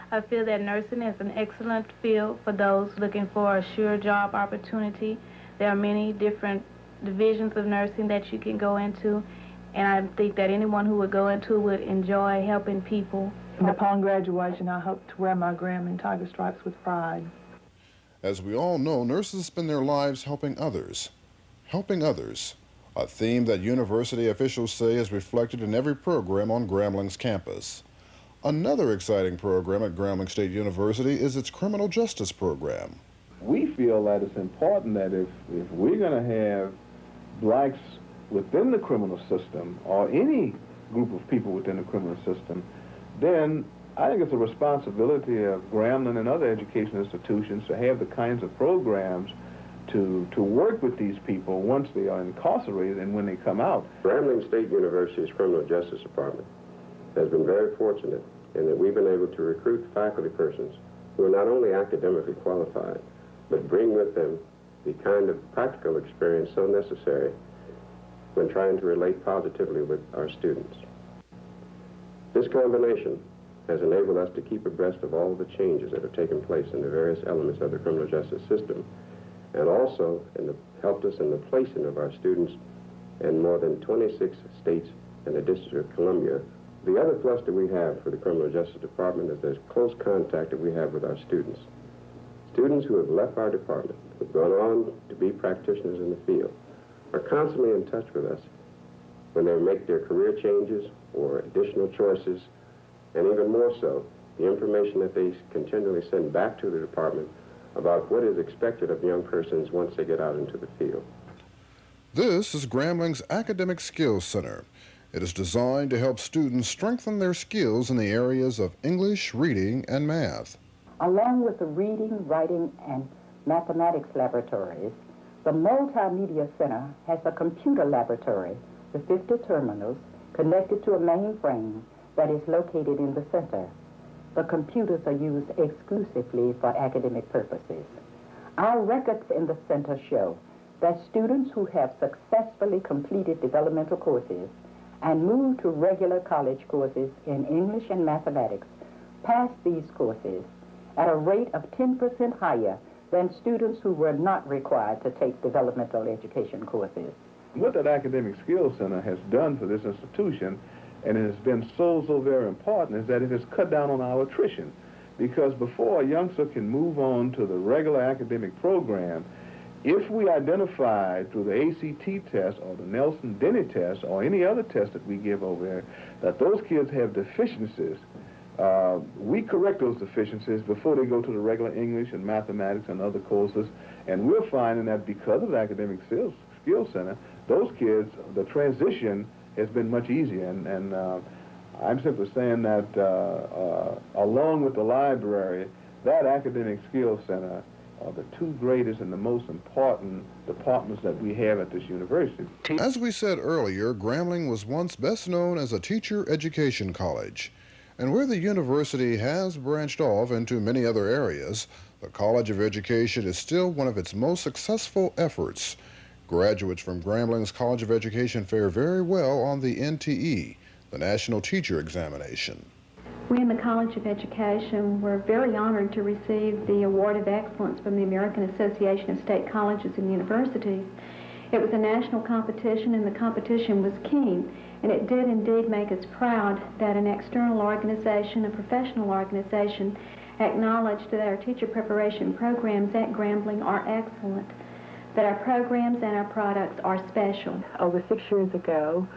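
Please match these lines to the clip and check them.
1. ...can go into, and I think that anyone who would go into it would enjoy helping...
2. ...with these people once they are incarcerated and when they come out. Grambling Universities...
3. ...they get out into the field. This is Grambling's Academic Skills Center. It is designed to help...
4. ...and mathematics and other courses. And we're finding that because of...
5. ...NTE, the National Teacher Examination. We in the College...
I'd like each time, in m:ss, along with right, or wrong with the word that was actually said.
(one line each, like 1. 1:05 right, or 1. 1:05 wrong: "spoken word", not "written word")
1. 0:08 right
2. 0:50 wrong: "State", not "Universities"
3. 1:49 right
4. 3:02 right
5. 3:39 right.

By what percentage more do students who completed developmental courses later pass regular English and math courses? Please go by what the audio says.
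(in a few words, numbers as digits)
10%.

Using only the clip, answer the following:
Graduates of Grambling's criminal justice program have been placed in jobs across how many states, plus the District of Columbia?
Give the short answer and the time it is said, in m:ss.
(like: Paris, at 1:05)
26, at 1:23.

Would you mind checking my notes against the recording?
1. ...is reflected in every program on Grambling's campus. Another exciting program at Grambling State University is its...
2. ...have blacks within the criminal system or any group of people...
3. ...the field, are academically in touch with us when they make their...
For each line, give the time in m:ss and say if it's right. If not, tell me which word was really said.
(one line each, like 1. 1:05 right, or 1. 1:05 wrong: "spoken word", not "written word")
1. 0:24 right
2. 0:36 right
3. 1:36 wrong: "constantly", not "academically".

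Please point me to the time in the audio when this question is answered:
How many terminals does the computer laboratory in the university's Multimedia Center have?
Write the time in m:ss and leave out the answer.
2:09.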